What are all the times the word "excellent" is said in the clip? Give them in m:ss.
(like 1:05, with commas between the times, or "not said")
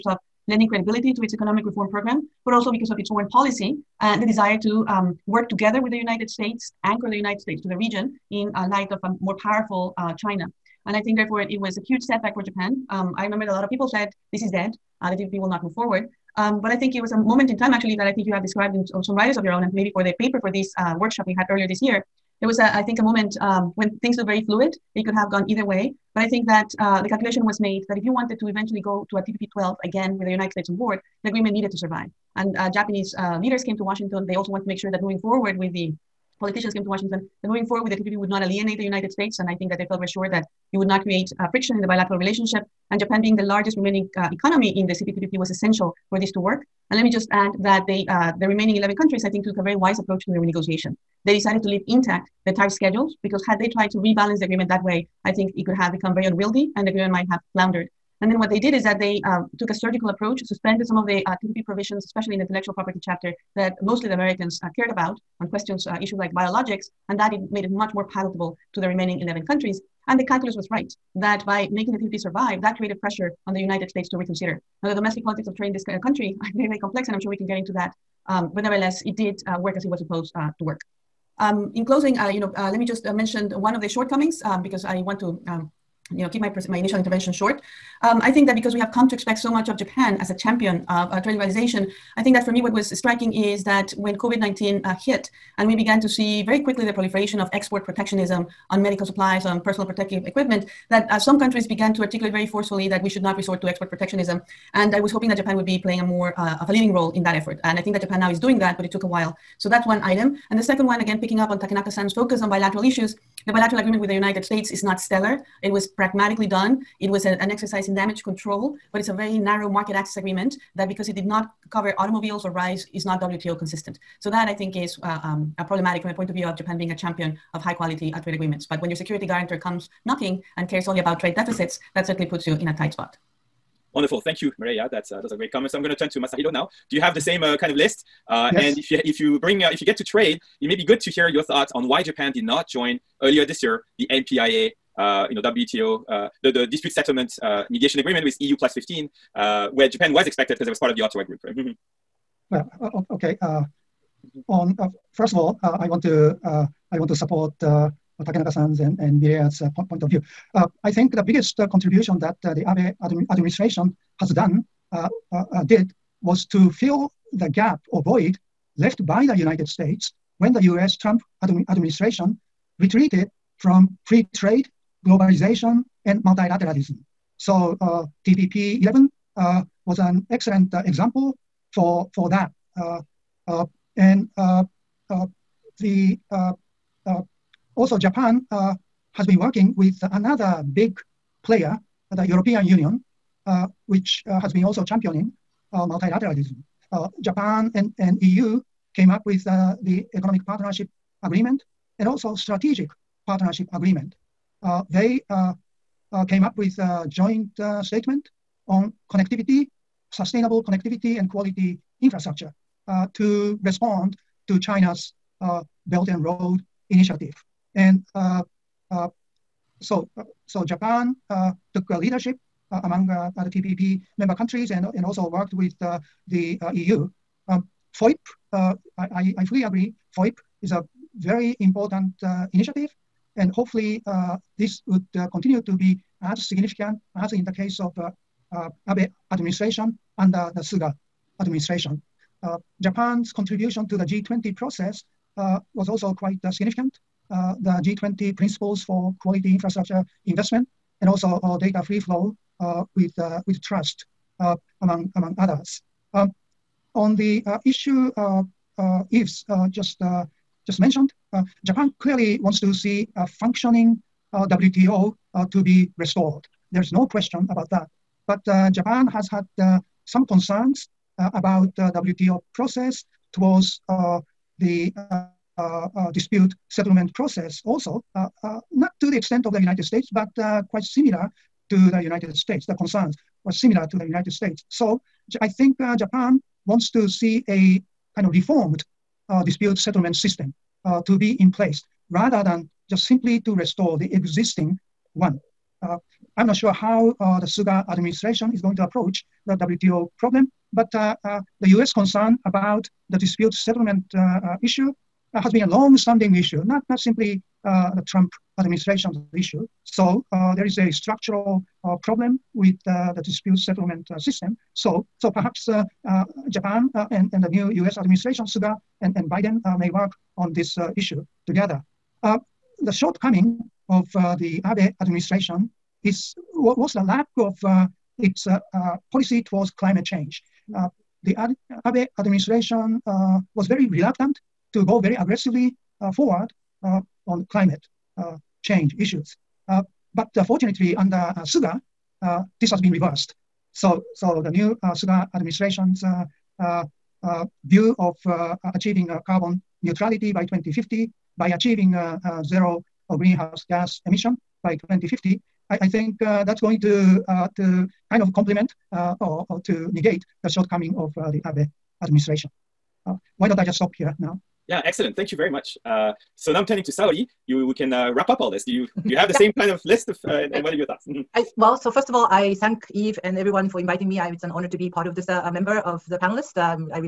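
3:00, 6:04.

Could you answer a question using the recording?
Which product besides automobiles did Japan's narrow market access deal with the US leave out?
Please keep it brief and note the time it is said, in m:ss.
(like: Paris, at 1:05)
Rice, at 2:02.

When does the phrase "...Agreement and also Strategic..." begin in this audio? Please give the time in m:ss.
3:21.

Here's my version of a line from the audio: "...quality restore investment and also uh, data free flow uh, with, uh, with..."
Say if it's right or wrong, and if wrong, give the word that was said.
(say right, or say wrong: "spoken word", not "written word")
wrong: "infrastructure", not "restore".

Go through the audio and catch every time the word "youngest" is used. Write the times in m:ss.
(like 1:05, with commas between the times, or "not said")
not said.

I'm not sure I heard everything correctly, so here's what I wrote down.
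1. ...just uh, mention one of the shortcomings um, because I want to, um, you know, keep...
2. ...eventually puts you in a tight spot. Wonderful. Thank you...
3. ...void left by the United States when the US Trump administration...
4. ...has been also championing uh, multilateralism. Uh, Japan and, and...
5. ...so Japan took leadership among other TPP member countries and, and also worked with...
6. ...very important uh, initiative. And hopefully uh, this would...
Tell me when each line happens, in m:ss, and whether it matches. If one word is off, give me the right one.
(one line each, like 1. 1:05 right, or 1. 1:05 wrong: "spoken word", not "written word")
1. 1:22 right
2. 2:12 wrong: "certainly", not "eventually"
3. 2:48 right
4. 3:14 right
5. 3:40 right
6. 3:51 right.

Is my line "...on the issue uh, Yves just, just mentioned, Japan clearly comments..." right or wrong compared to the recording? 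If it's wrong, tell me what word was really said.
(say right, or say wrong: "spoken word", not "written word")
wrong: "wants", not "comments".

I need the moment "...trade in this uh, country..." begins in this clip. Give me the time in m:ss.
1:15.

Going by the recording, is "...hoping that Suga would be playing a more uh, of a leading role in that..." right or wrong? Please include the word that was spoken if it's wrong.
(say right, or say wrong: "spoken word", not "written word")
wrong: "Japan", not "Suga".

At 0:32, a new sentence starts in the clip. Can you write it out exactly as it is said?
And uh, Japanese uh, leaders came to Washington.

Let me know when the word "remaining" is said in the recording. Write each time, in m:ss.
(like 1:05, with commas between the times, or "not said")
0:43, 0:48, 1:08.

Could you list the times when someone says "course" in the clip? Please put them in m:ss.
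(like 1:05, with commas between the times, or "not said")
not said.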